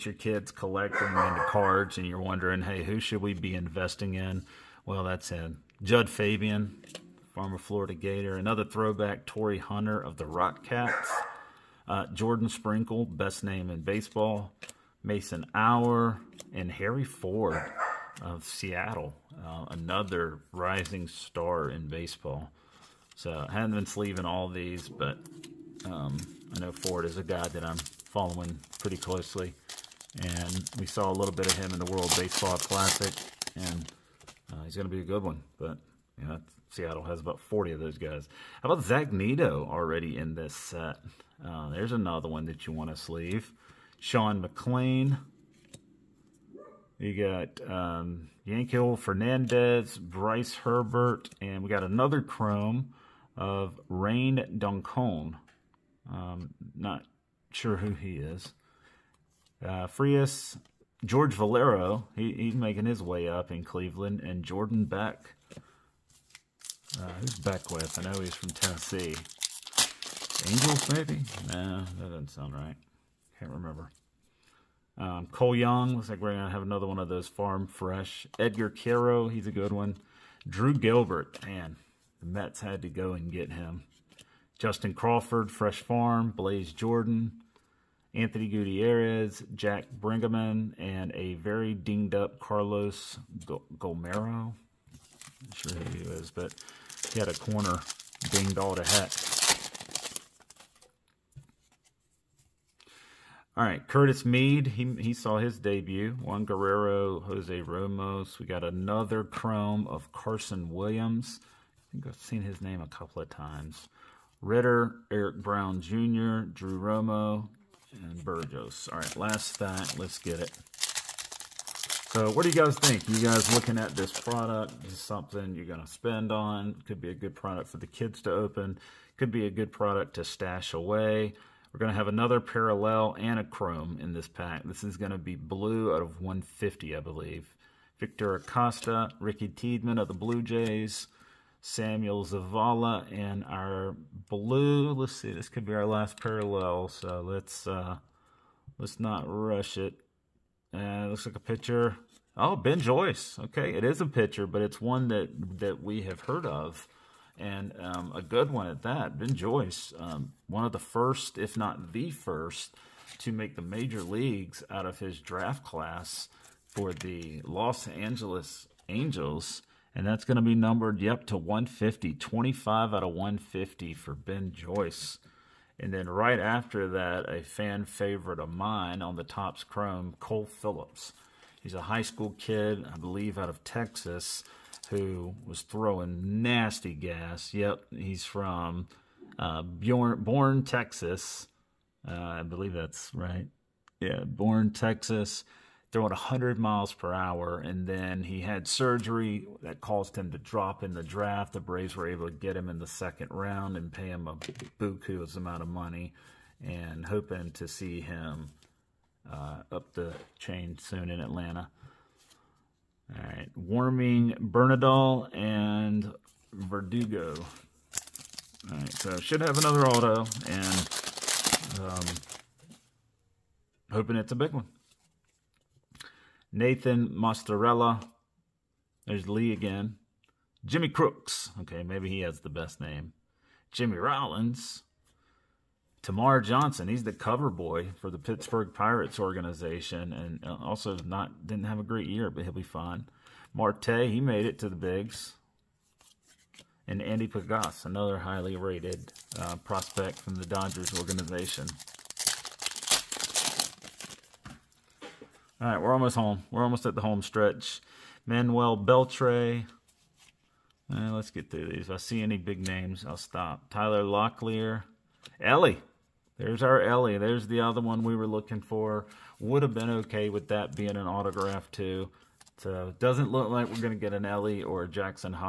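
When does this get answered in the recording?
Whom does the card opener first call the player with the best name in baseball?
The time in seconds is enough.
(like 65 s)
12 s.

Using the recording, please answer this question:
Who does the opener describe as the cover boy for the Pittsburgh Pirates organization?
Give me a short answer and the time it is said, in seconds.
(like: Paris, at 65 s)
Termarr Johnson, at 236 s.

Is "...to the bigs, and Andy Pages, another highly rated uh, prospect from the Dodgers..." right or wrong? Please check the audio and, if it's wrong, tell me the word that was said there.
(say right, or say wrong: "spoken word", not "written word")
right.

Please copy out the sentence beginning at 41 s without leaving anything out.
Uh, there's another one that you want to sleeve.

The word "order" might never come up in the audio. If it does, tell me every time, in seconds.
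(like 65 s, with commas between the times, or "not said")
not said.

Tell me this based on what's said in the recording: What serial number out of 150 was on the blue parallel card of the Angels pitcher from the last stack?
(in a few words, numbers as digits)
25.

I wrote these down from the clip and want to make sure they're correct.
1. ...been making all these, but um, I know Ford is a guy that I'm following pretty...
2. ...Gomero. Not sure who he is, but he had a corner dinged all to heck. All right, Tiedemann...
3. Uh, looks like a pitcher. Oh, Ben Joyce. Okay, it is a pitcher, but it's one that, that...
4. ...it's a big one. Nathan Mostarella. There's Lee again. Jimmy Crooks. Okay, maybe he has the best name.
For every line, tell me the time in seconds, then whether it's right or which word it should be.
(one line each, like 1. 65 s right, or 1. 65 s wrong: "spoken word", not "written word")
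1. 23 s wrong: "sleeving", not "making"
2. 93 s wrong: "Curtis", not "Tiedemann"
3. 150 s right
4. 224 s right.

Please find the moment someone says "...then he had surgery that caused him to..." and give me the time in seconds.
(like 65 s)
197 s.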